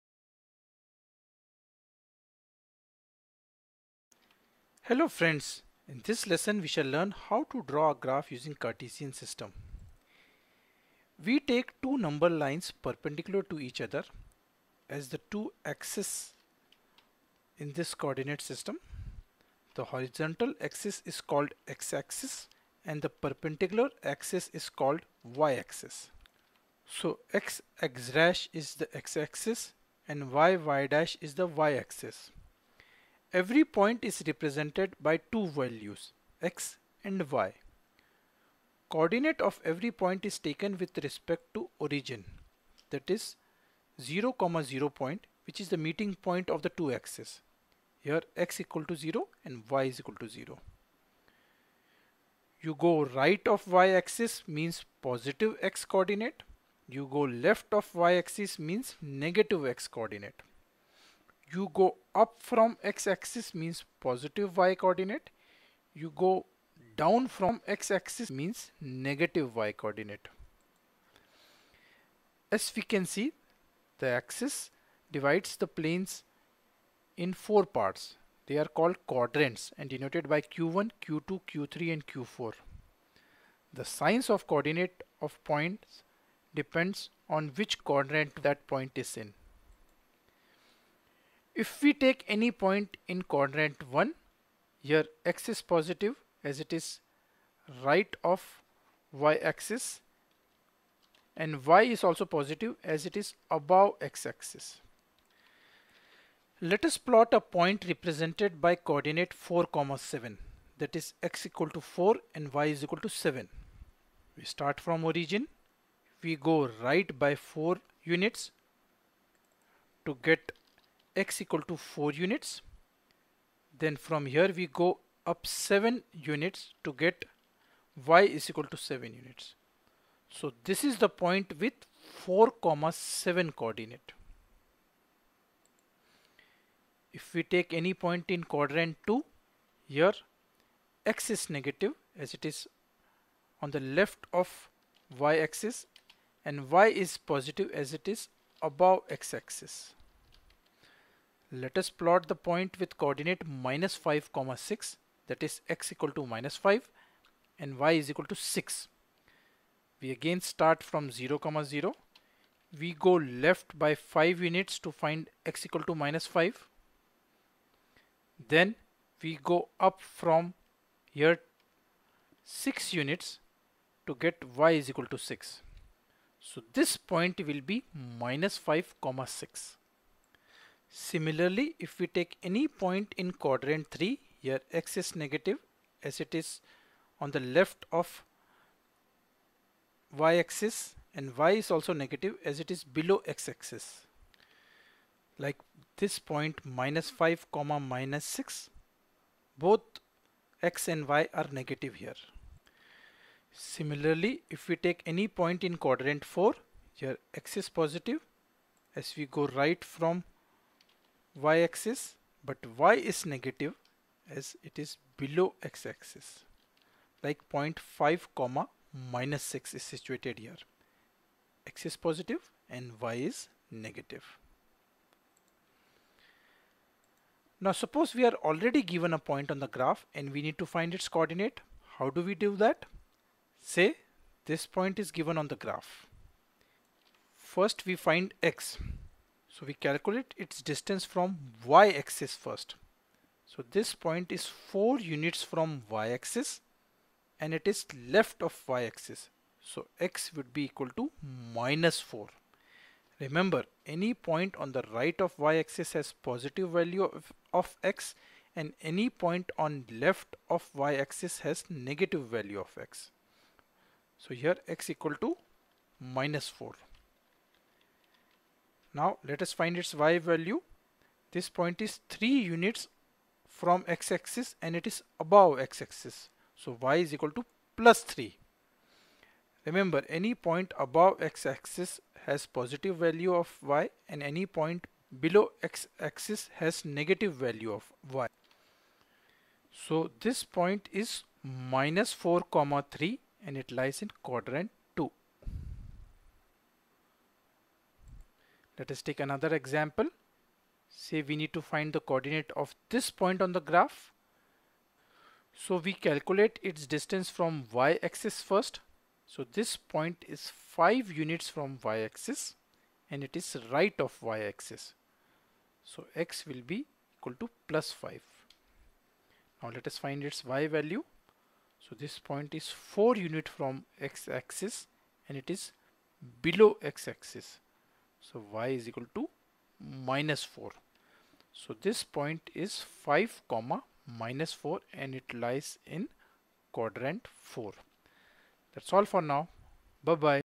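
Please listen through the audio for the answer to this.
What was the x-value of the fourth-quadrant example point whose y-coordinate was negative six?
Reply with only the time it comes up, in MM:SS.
03:37.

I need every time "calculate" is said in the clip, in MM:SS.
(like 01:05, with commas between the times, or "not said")
03:59, 05:05.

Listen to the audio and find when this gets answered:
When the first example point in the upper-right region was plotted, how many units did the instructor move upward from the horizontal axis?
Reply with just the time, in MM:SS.
02:04.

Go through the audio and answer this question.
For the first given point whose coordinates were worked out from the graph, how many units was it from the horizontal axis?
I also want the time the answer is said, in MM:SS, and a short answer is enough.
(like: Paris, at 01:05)
3 units, at 04:32.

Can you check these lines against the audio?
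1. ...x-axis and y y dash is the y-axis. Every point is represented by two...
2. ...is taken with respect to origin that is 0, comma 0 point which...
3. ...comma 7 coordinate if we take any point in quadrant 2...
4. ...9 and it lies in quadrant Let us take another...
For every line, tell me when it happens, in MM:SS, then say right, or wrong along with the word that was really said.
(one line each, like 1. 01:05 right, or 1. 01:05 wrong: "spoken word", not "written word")
1. 00:28 right
2. 00:40 right
3. 02:12 right
4. 04:52 wrong: "3", not "9".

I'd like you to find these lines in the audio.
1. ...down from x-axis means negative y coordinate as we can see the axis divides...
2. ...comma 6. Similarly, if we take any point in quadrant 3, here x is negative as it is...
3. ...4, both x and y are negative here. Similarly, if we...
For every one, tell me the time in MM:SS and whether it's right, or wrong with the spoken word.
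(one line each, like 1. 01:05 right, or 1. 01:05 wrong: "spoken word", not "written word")
1. 01:07 right
2. 02:59 right
3. 03:18 wrong: "6", not "4".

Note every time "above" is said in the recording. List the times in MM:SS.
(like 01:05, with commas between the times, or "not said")
01:43, 02:28, 04:35, 04:40.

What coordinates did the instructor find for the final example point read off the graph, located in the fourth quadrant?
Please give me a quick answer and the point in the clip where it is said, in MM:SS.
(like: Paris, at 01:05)
(5, -4), at 05:33.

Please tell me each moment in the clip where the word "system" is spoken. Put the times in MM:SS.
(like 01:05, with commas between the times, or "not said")
00:09, 00:18.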